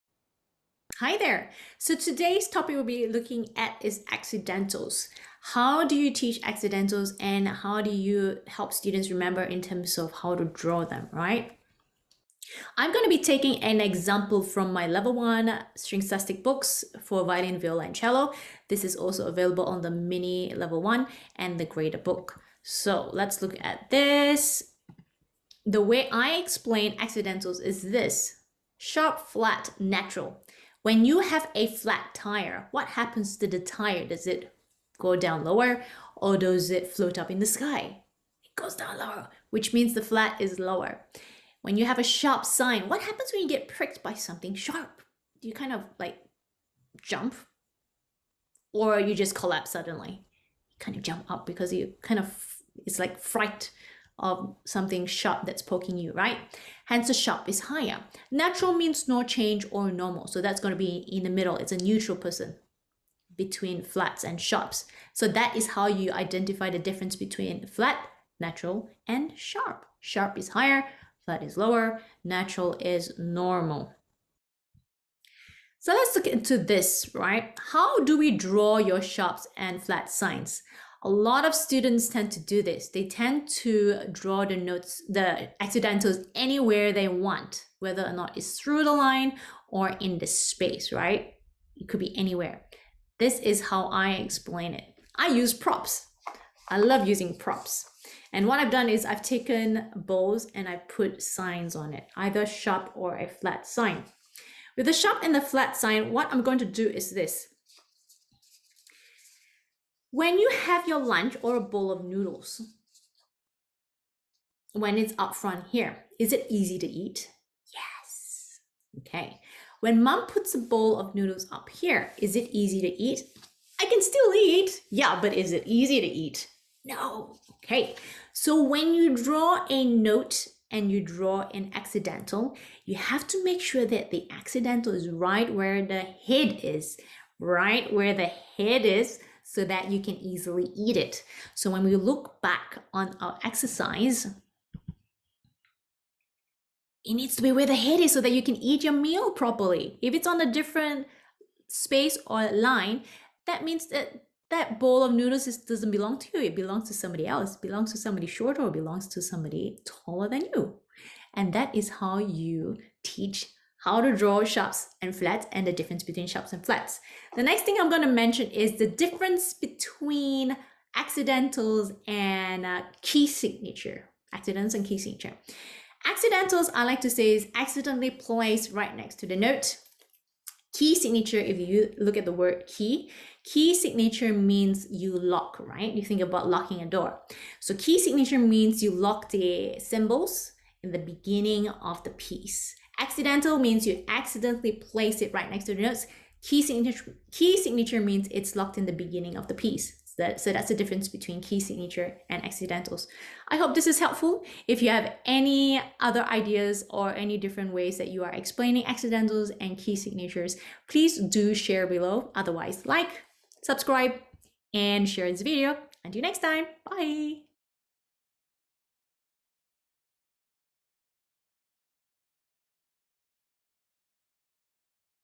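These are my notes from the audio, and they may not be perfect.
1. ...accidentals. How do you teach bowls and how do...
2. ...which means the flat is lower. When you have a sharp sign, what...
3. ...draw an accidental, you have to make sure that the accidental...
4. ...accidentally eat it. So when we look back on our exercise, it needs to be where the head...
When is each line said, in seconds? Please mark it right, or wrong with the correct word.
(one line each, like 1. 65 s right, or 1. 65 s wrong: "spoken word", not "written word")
1. 4 s wrong: "accidentals", not "bowls"
2. 39 s right
3. 130 s right
4. 140 s wrong: "easily", not "accidentally".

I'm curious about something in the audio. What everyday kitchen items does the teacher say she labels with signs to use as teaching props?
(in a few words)
Bowls.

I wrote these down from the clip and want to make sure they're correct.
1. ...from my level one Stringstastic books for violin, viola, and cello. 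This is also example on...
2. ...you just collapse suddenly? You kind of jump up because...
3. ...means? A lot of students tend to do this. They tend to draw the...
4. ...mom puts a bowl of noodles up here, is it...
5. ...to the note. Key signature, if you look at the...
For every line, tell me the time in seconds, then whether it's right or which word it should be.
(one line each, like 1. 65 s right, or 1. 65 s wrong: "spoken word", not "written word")
1. 14 s wrong: "available", not "example"
2. 48 s right
3. 80 s wrong: "signs", not "means"
4. 120 s right
5. 179 s right.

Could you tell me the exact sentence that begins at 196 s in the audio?
Key signature, key signature means it's locked in the beginning of the piece.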